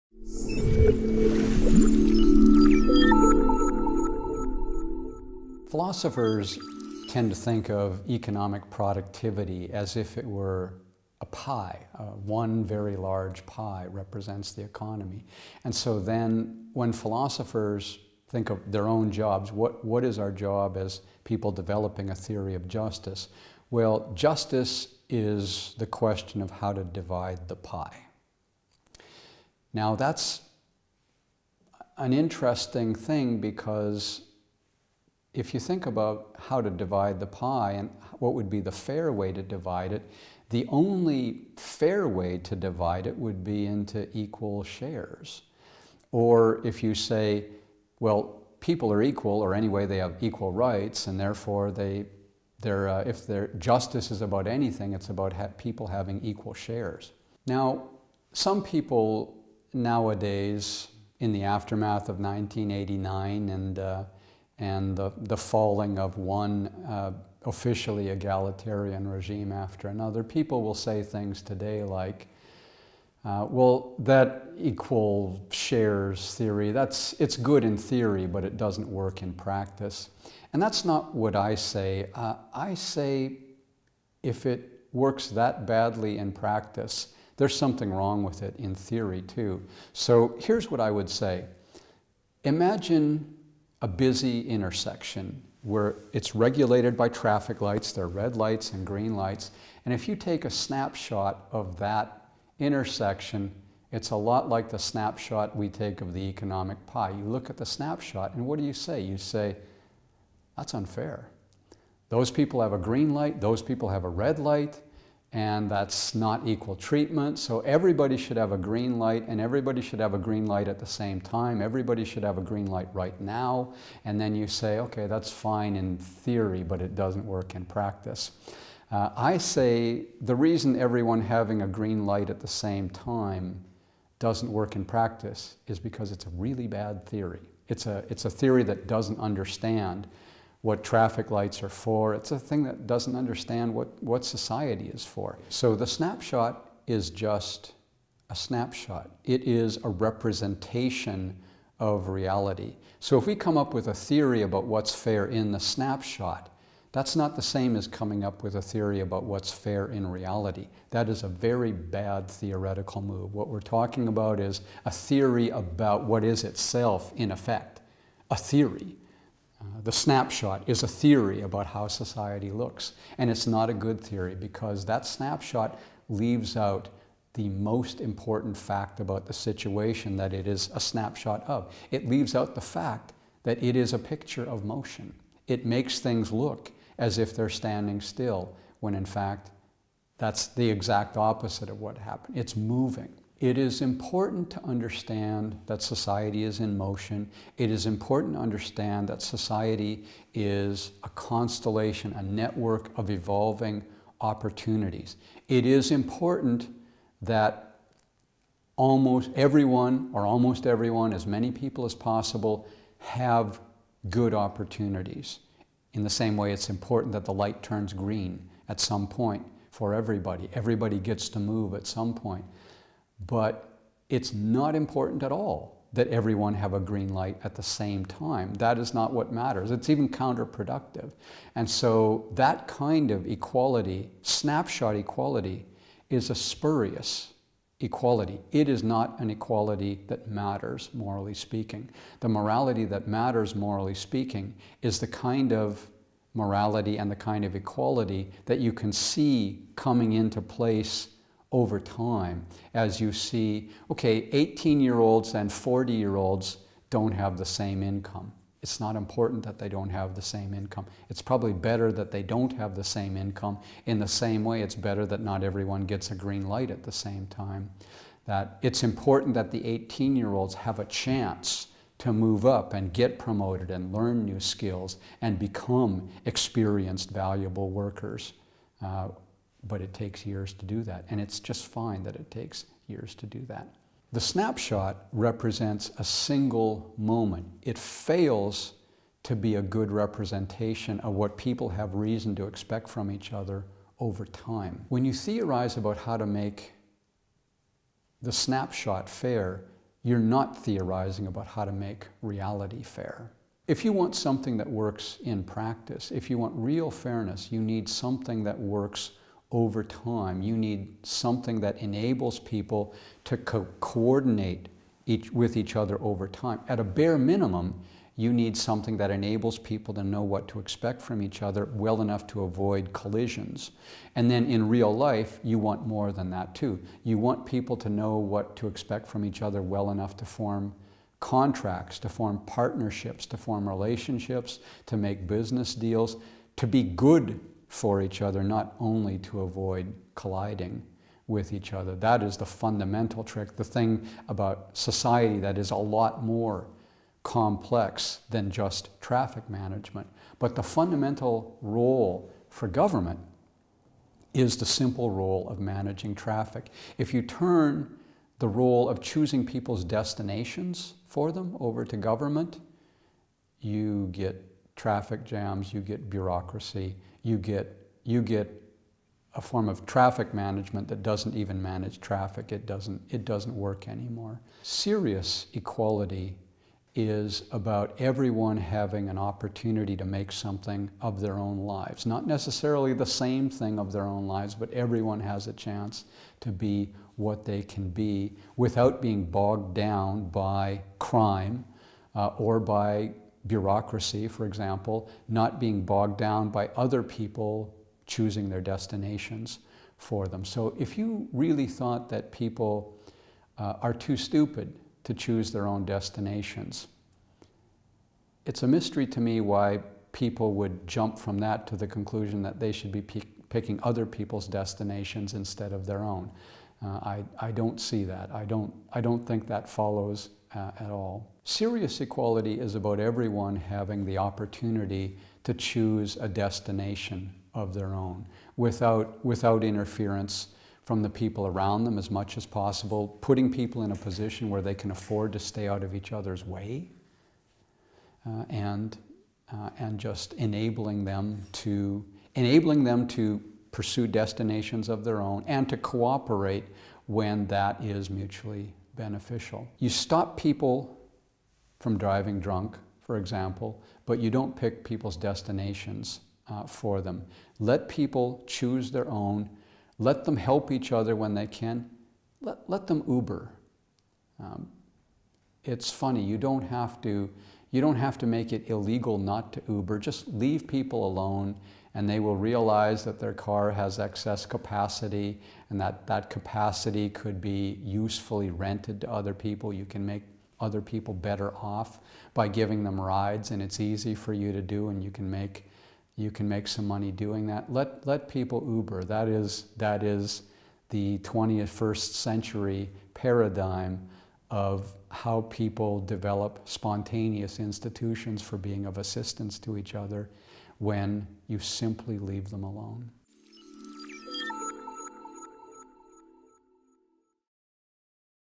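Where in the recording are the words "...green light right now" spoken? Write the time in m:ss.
2:02.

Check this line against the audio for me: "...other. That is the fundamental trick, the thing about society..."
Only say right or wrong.
right.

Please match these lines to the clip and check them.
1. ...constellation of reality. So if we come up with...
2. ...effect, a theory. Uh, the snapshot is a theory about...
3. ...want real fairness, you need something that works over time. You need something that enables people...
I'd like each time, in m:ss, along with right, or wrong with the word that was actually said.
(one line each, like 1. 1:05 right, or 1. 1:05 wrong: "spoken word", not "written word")
1. 2:29 wrong: "representation", not "constellation"
2. 2:47 right
3. 5:06 right.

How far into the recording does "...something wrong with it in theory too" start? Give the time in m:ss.
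1:27.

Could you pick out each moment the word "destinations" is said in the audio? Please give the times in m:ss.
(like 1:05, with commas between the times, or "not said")
5:59, 6:38, 6:45, 6:54, 7:06, 7:24, 7:35.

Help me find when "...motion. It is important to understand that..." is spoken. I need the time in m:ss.
3:16.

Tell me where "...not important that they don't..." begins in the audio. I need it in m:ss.
4:18.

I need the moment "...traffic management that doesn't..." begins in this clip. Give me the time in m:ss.
6:09.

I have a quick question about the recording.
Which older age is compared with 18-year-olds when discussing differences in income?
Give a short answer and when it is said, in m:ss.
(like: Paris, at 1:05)
40, at 4:15.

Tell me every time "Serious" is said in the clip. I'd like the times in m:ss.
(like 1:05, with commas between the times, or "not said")
6:14, 7:01.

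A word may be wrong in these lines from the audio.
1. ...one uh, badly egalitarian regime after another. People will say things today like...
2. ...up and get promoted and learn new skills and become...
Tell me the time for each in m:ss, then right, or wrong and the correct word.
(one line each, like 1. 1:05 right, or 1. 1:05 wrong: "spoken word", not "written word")
1. 1:06 wrong: "officially", not "badly"
2. 4:32 right.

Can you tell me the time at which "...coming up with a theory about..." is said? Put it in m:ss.
2:37.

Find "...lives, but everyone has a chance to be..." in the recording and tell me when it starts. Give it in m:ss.
6:24.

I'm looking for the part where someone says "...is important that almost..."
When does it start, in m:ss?
3:25.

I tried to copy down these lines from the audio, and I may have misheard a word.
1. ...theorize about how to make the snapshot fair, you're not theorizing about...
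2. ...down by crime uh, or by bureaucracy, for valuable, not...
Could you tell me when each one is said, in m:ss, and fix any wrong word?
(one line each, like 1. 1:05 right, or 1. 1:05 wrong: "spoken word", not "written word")
1. 4:55 right
2. 6:29 wrong: "example", not "valuable".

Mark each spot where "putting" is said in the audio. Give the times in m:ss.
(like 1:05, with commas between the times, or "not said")
7:13.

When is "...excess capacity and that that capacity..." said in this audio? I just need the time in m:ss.
7:53.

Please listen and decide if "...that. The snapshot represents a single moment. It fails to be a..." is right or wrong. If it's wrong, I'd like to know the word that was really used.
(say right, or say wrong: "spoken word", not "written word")
right.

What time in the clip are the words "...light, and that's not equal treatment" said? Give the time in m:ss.
1:54.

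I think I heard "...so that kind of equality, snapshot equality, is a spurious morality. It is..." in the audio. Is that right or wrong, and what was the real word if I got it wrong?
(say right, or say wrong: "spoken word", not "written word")
wrong: "equality", not "morality".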